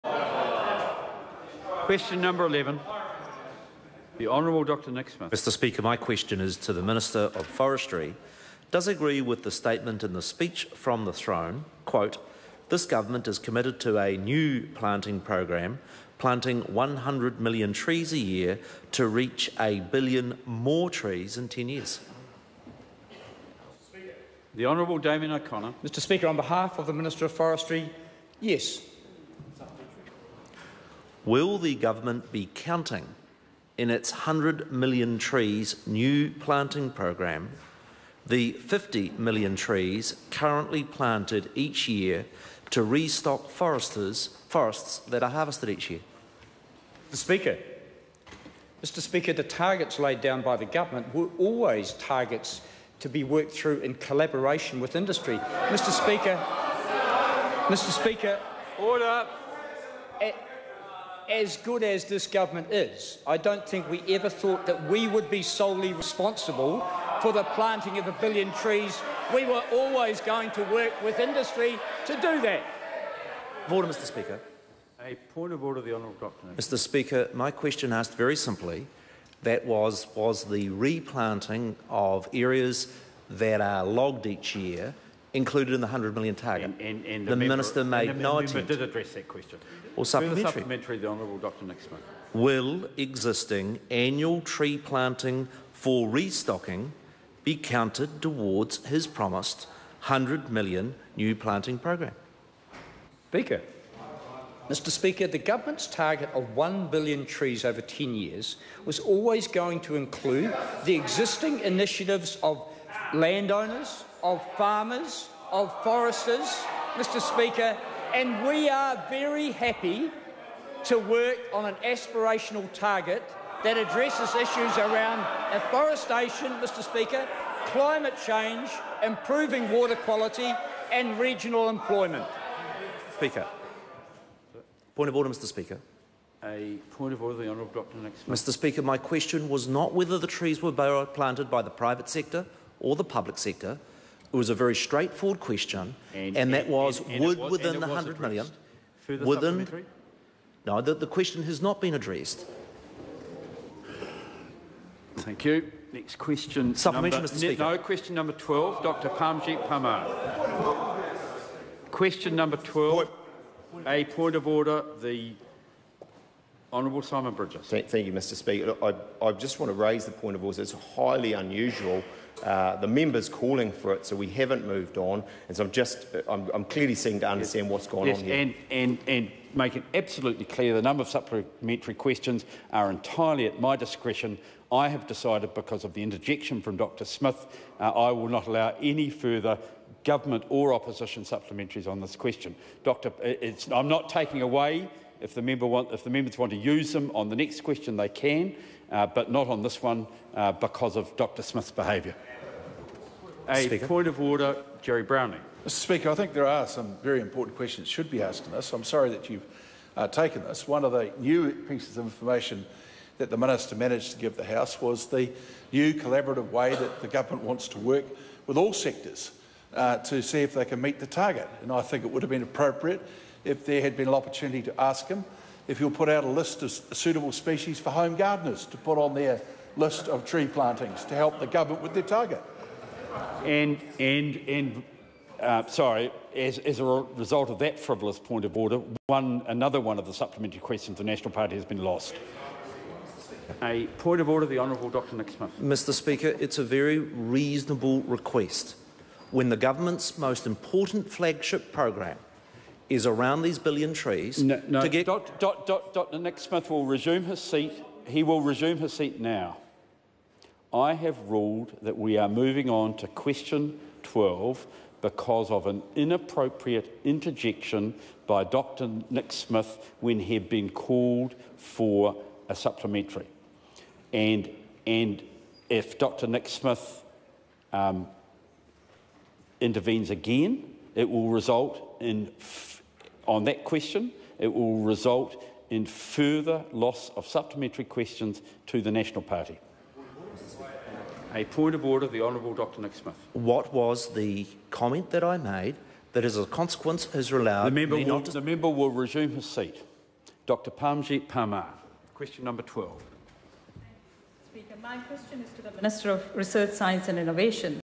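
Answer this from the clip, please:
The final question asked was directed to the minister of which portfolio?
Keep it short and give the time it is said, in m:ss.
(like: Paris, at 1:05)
Research, Science and Innovation, at 5:06.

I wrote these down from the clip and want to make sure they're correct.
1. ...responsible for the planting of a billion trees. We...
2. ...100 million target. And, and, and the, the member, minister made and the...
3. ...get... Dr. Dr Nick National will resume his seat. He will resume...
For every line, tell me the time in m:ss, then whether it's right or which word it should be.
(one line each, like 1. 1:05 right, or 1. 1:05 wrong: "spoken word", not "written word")
1. 1:05 right
2. 1:25 right
3. 4:14 wrong: "Smith", not "National".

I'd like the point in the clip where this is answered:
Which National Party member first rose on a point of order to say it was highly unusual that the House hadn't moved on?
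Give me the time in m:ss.
2:47.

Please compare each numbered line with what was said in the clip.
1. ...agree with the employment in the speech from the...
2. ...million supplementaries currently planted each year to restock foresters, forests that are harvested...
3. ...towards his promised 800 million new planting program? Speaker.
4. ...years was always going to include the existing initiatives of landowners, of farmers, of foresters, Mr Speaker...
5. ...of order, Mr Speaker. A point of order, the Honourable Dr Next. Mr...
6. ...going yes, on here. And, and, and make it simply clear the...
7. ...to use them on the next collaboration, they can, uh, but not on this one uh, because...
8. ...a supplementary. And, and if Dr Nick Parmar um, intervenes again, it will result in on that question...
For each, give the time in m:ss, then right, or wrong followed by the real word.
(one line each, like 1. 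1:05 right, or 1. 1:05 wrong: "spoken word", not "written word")
1. 0:08 wrong: "statement", not "employment"
2. 0:39 wrong: "trees", not "supplementaries"
3. 1:38 wrong: "100", not "800"
4. 1:48 right
5. 2:15 right
6. 2:57 wrong: "absolutely", not "simply"
7. 3:16 wrong: "question", not "collaboration"
8. 4:32 wrong: "Smith", not "Parmar".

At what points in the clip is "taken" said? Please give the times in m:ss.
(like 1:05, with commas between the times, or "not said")
3:30.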